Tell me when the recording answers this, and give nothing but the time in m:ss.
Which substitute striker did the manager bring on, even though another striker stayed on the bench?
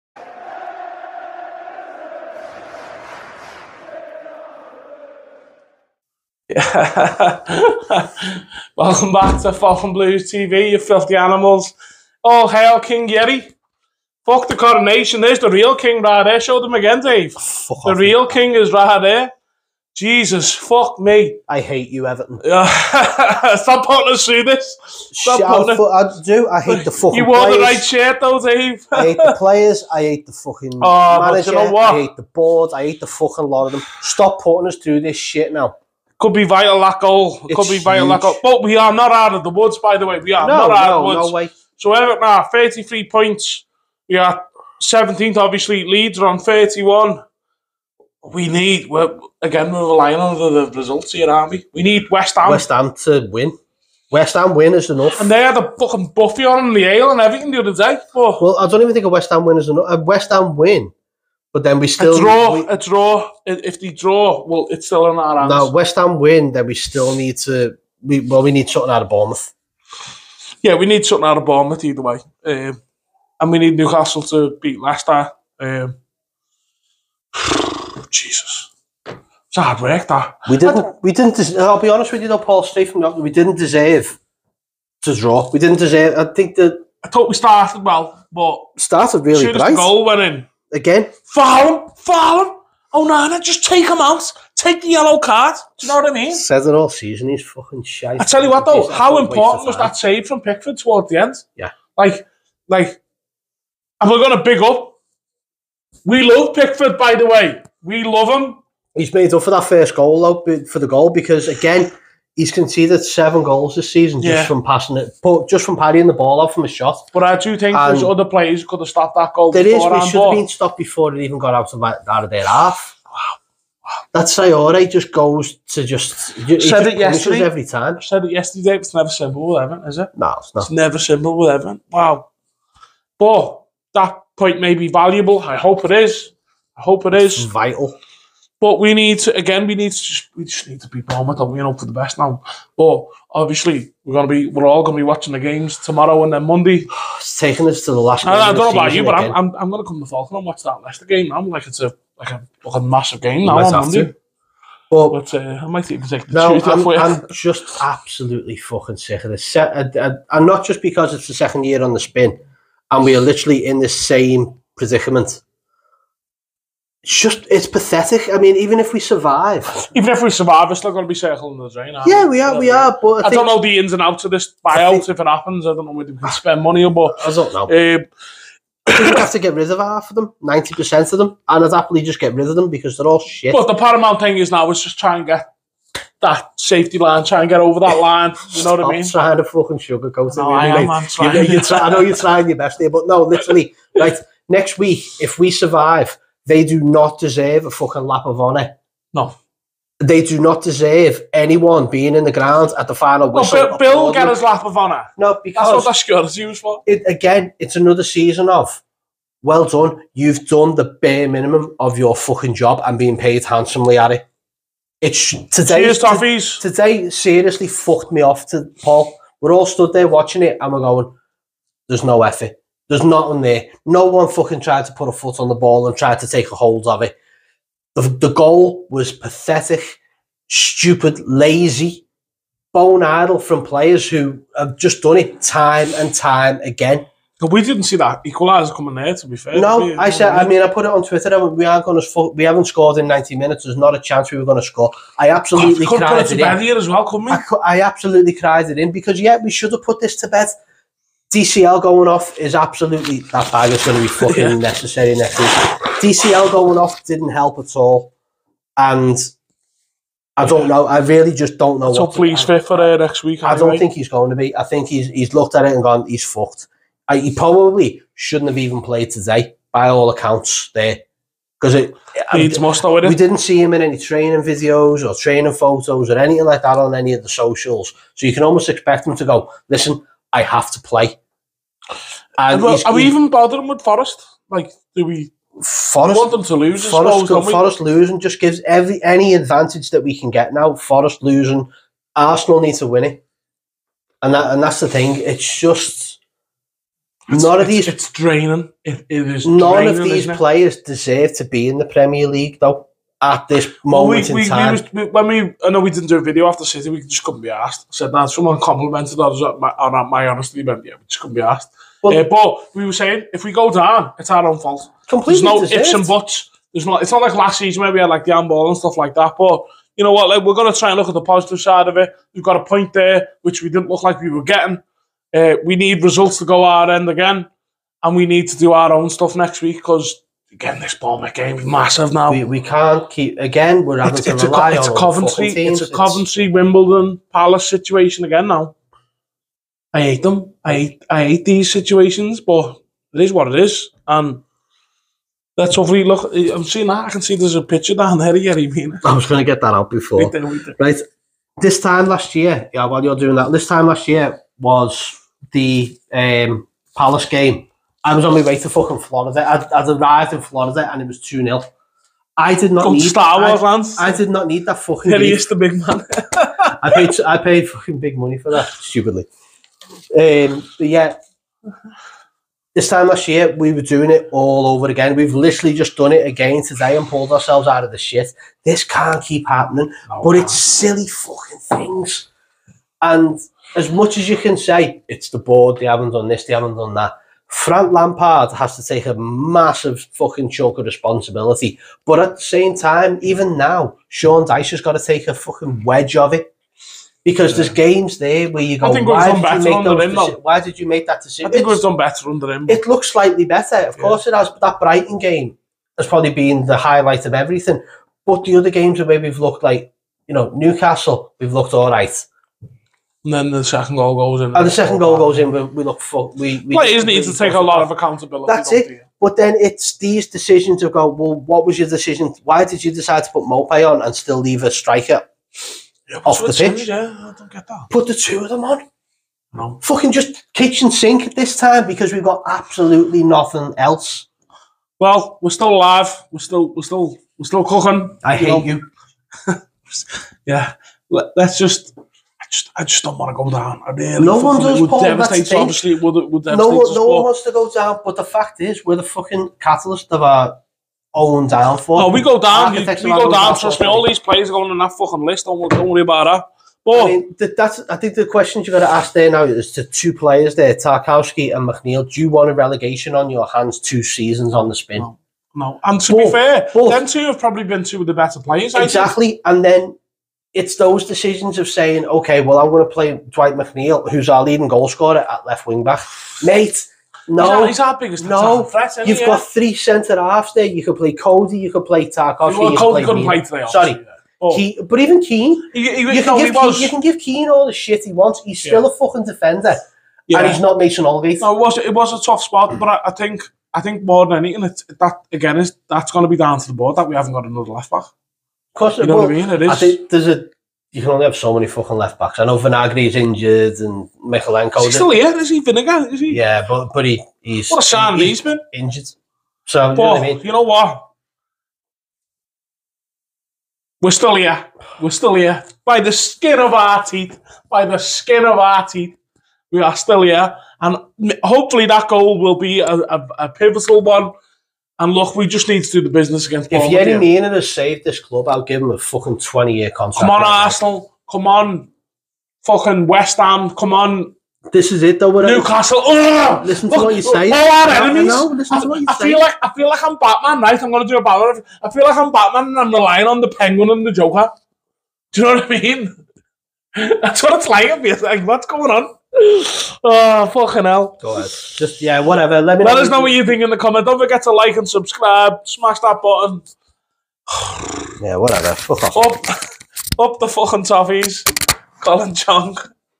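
7:03.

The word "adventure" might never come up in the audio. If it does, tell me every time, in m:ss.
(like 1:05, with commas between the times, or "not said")
not said.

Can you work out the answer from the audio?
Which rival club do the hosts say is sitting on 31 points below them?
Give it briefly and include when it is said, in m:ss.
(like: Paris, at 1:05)
Leeds, at 0:45.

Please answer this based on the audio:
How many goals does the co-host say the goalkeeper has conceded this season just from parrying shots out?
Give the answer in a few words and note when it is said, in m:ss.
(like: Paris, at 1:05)
7, at 1:53.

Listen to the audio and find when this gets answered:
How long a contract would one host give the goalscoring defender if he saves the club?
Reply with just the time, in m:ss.
8:49.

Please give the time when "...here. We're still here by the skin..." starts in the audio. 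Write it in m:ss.
8:34.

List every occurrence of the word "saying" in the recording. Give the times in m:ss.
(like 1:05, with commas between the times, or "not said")
5:12, 7:51.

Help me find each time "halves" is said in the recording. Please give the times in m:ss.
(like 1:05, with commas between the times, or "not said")
8:00.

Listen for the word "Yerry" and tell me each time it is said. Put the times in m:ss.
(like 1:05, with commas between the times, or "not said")
0:13, 5:48, 8:46.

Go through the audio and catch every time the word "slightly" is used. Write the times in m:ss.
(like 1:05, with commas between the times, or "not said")
6:43.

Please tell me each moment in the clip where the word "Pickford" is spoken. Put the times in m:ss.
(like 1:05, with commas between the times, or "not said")
1:40, 1:46.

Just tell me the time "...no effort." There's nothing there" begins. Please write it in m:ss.
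3:42.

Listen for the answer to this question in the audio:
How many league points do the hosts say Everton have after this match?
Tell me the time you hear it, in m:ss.
0:42.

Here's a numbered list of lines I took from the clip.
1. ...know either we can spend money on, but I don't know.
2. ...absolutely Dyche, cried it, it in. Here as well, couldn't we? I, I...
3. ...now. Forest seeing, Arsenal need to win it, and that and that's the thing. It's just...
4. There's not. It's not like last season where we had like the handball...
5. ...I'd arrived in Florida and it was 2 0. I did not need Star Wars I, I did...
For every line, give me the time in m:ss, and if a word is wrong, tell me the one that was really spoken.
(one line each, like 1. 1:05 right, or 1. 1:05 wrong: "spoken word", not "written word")
1. 2:55 wrong: "whether", not "either"
2. 4:05 wrong: "God", not "Dyche"
3. 4:50 wrong: "losing", not "seeing"
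4. 5:16 right
5. 5:59 right.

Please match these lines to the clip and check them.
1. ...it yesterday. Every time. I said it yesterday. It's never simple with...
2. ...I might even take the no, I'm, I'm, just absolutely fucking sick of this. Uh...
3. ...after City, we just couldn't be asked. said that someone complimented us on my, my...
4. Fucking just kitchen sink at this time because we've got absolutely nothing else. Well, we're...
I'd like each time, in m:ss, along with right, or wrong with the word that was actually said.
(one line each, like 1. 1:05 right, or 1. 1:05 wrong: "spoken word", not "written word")
1. 2:06 right
2. 2:35 right
3. 5:06 right
4. 7:09 right.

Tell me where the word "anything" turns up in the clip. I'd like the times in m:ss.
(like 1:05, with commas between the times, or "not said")
4:36, 8:14.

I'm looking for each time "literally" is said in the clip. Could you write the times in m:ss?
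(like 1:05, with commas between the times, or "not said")
2:43, 3:13, 6:15.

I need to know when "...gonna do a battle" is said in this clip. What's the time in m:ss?
9:00.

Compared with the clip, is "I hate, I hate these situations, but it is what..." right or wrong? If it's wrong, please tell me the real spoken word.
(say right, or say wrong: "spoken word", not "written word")
right.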